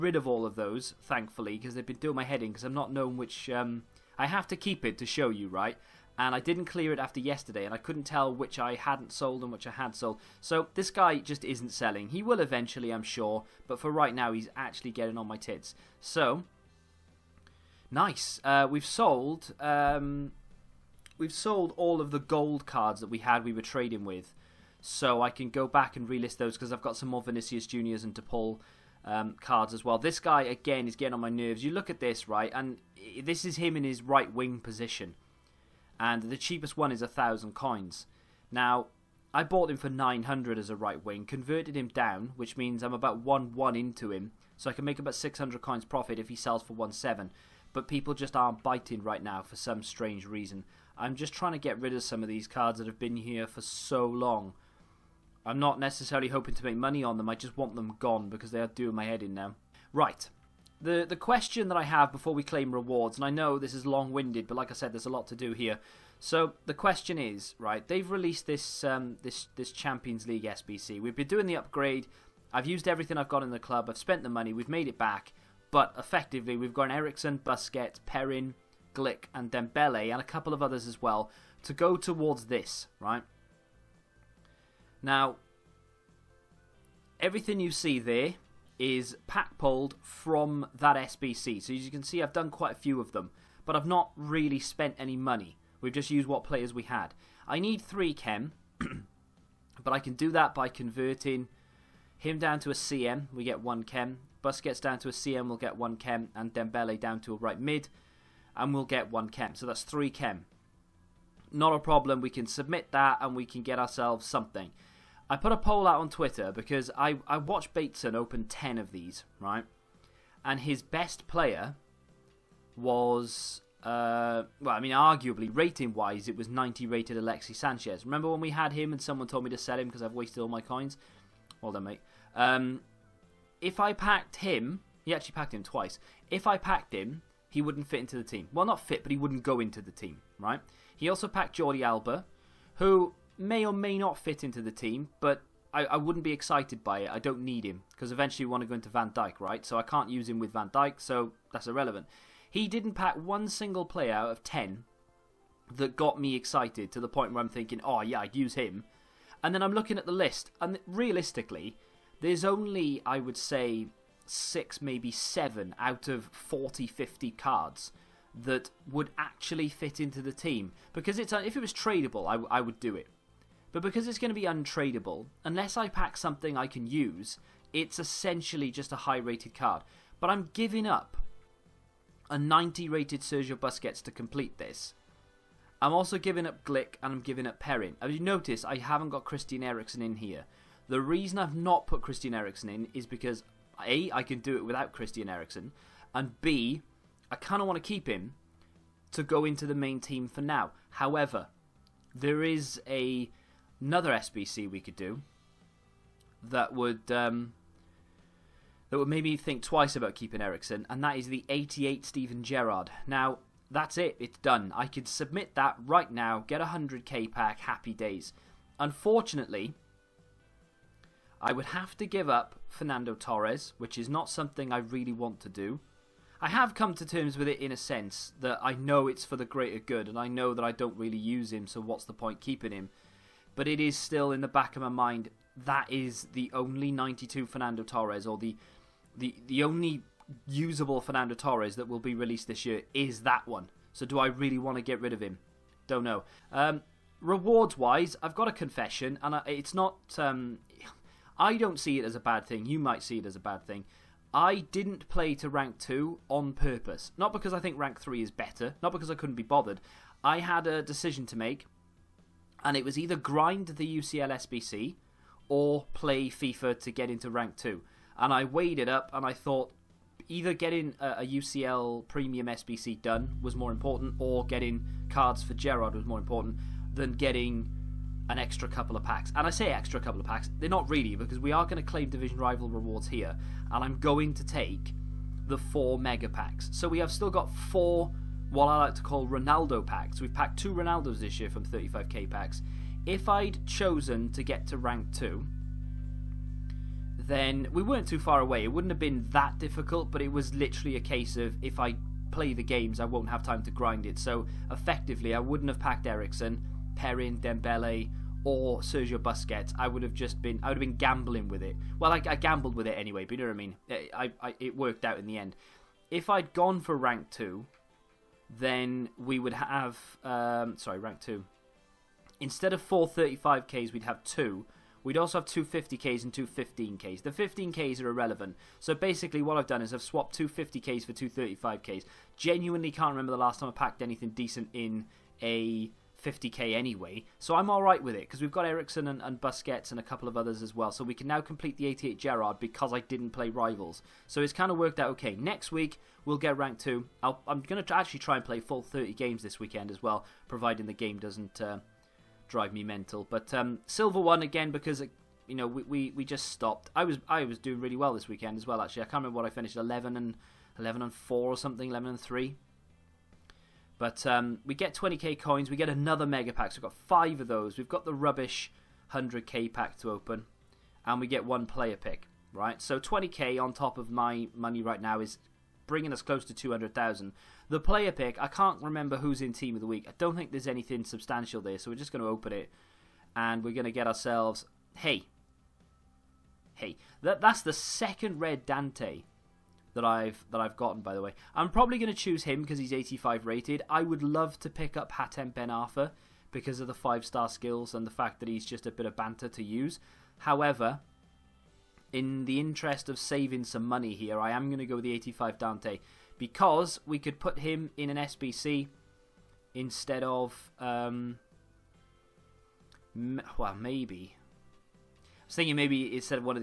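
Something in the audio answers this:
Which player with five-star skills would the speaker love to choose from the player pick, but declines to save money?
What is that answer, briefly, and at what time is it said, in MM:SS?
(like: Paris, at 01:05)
Hatem Ben Arfa, at 06:35.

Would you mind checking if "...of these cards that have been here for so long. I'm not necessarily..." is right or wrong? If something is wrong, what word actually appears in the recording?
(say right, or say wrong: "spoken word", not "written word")
right.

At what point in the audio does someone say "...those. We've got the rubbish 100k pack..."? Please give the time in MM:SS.
06:07.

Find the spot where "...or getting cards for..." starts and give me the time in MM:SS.
04:34.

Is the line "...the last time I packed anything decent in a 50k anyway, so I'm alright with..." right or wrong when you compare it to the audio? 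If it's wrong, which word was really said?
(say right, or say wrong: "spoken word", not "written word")
right.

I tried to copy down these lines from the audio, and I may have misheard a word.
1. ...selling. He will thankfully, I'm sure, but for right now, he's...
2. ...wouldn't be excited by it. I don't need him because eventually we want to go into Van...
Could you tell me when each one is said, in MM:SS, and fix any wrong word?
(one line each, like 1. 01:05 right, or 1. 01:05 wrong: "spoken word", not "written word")
1. 00:11 wrong: "eventually", not "thankfully"
2. 02:25 right.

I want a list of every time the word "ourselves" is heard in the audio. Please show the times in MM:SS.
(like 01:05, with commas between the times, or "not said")
01:53, 06:24.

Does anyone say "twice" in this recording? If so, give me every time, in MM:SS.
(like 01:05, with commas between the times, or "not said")
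02:15, 03:29.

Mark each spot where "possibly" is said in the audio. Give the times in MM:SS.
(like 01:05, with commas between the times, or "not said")
not said.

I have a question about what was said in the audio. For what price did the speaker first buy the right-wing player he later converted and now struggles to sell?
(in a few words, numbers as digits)
900.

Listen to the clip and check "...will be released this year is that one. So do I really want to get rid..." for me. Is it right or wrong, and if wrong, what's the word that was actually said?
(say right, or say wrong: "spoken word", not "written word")
right.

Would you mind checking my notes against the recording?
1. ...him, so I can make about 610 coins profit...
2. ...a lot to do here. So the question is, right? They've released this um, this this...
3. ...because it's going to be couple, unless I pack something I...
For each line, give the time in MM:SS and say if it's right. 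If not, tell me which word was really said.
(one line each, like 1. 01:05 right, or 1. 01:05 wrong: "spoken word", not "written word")
1. 00:44 wrong: "600", not "610"
2. 01:05 right
3. 02:53 wrong: "untradeable", not "couple".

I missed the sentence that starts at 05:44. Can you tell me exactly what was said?
So it's kind of worked out okay.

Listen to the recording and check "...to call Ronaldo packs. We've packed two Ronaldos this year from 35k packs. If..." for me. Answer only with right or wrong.
right.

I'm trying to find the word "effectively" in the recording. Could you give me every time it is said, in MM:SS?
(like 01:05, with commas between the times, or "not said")
01:15, 05:04.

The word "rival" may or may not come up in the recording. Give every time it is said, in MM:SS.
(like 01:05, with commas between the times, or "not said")
04:42, 05:43.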